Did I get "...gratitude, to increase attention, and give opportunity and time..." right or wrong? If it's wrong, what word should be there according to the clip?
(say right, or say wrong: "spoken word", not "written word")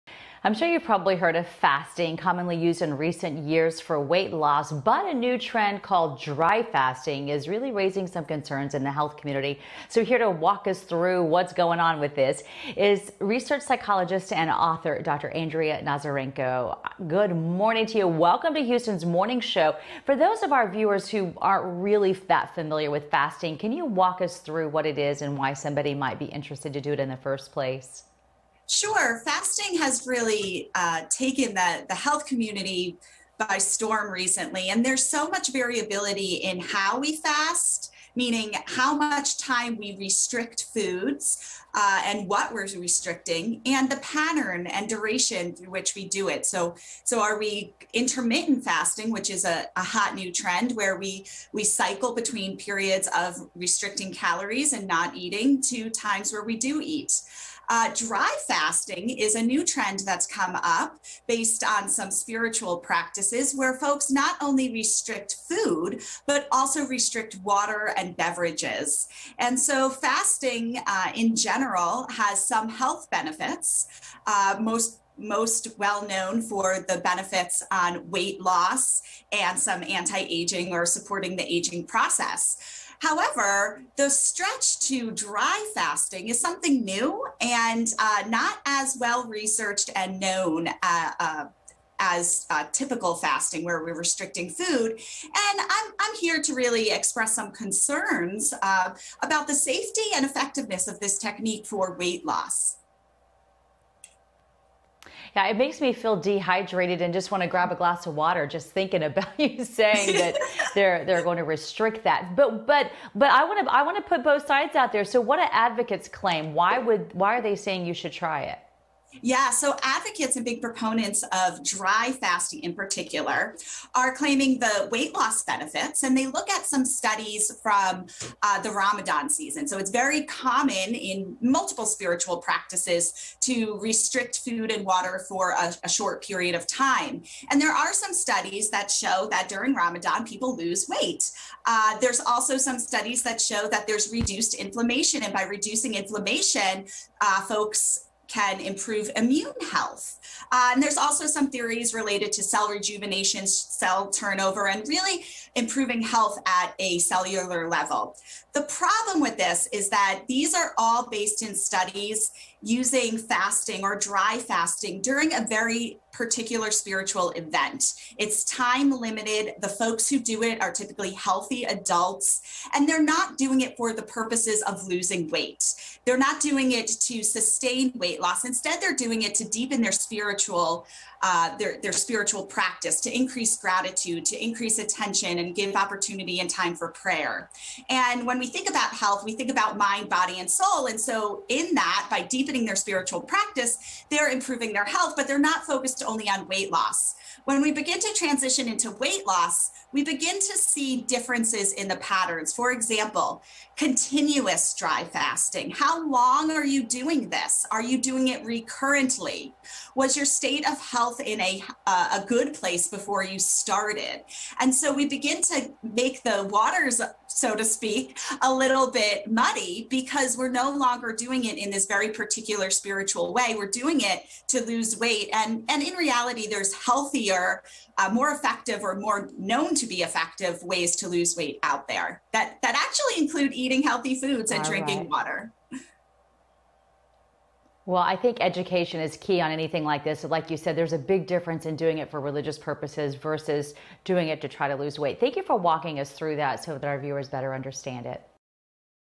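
right.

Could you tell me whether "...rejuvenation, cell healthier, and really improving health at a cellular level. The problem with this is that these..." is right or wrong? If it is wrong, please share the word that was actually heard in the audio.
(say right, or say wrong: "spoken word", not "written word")
wrong: "turnover", not "healthier".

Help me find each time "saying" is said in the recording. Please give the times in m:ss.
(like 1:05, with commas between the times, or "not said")
1:49, 1:57.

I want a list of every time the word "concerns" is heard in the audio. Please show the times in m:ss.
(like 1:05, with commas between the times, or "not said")
0:08, 1:37.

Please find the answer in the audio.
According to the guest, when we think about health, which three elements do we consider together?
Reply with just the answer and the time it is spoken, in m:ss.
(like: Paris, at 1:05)
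mind, body, and soul, at 3:09.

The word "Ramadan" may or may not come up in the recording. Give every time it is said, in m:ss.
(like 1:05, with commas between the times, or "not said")
2:08, 2:19.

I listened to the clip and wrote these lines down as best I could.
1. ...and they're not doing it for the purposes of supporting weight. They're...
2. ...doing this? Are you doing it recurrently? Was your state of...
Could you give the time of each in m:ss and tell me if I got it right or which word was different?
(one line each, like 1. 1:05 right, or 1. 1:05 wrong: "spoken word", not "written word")
1. 2:52 wrong: "losing", not "supporting"
2. 3:26 right.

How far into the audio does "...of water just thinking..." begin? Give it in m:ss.
1:48.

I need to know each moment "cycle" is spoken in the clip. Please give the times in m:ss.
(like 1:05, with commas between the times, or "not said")
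0:51.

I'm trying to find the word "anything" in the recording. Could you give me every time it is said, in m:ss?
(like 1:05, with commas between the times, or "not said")
3:59.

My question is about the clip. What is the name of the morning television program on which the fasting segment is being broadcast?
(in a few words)
Houston's Morning Show.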